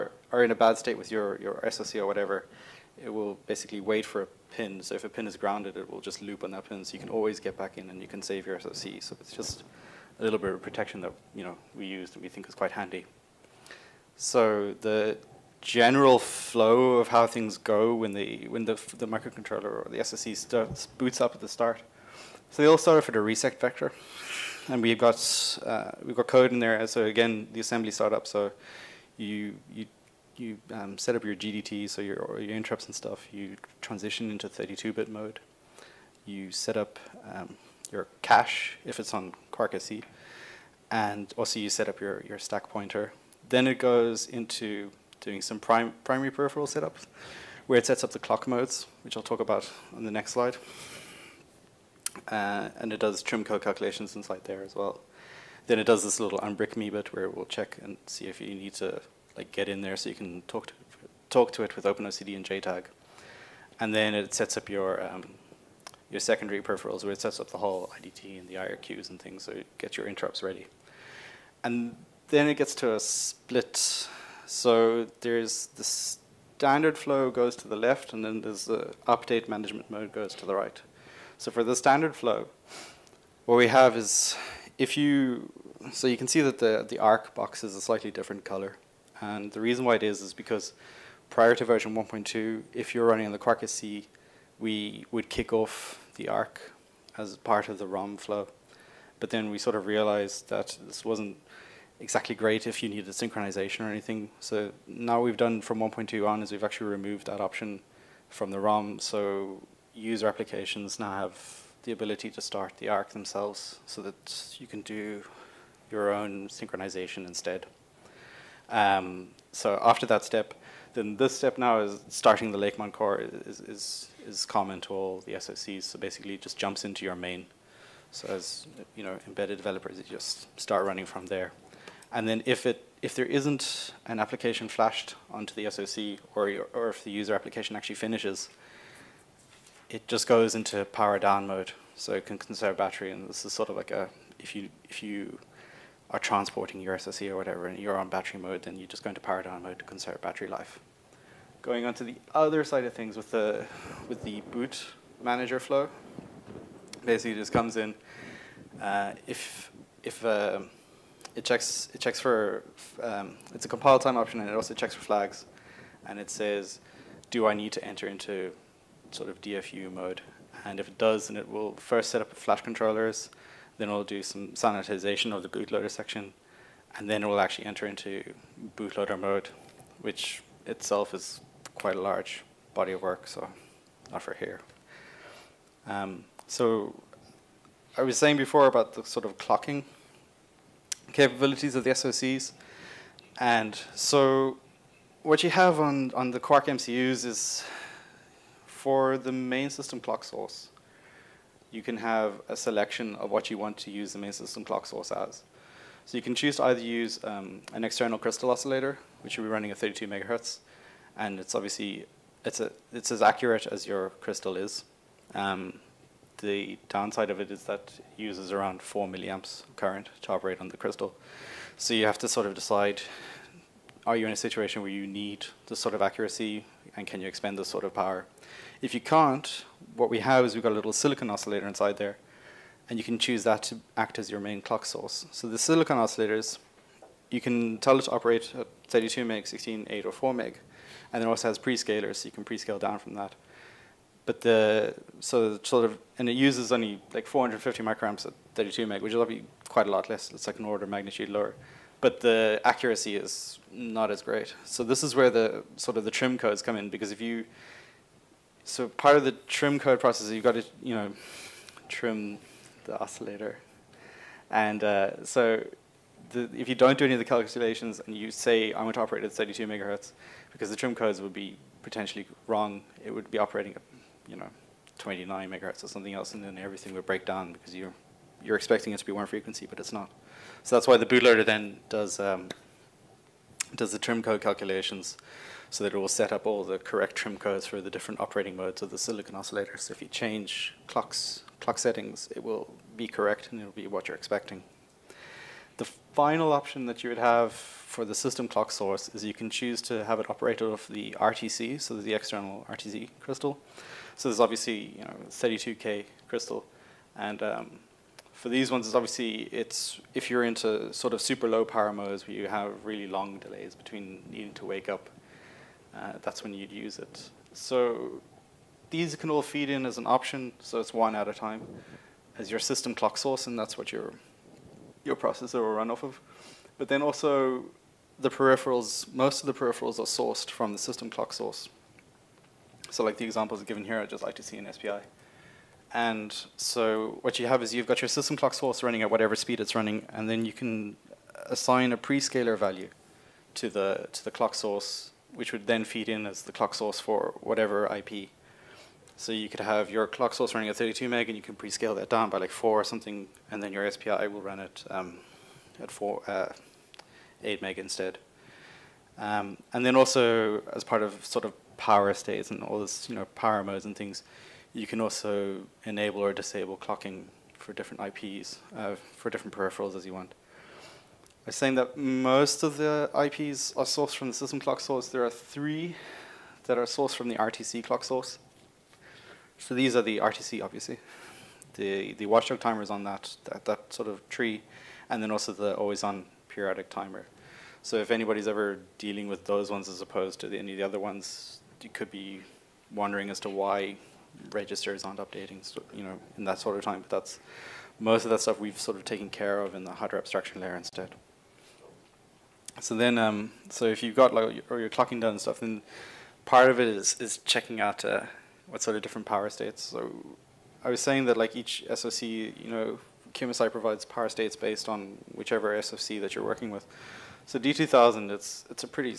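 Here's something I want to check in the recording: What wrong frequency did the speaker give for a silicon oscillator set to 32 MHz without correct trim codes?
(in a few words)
29 MHz.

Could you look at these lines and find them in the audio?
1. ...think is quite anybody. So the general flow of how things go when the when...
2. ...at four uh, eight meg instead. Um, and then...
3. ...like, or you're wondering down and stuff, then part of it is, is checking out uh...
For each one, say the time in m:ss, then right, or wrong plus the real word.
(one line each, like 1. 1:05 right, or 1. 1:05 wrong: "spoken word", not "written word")
1. 0:12 wrong: "handy", not "anybody"
2. 5:55 right
3. 6:44 wrong: "clocking", not "wondering".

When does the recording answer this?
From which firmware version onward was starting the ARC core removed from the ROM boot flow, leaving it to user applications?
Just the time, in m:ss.
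1:45.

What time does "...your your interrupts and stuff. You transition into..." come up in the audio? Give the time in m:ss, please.
0:32.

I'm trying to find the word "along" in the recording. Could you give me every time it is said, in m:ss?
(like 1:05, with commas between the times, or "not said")
not said.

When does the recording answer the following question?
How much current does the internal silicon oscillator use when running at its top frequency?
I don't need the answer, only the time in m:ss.
4:07.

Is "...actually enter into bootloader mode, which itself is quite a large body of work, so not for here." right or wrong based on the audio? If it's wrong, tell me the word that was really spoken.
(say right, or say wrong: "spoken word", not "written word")
right.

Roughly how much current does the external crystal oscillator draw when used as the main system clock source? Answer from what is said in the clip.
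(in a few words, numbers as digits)
4 milliamps.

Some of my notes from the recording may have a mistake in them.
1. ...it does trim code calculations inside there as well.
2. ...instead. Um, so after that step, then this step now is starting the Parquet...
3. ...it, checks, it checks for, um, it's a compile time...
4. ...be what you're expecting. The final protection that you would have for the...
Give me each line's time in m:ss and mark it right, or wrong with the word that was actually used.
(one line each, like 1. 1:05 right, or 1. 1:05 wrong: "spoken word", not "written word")
1. 0:52 right
2. 1:57 wrong: "Lakemont", not "Parquet"
3. 2:41 right
4. 4:53 wrong: "option", not "protection".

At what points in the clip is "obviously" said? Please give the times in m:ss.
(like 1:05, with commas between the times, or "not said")
3:31, 5:04, 5:08, 6:20.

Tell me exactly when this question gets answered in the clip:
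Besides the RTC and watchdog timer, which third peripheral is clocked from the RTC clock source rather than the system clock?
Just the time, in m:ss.
6:25.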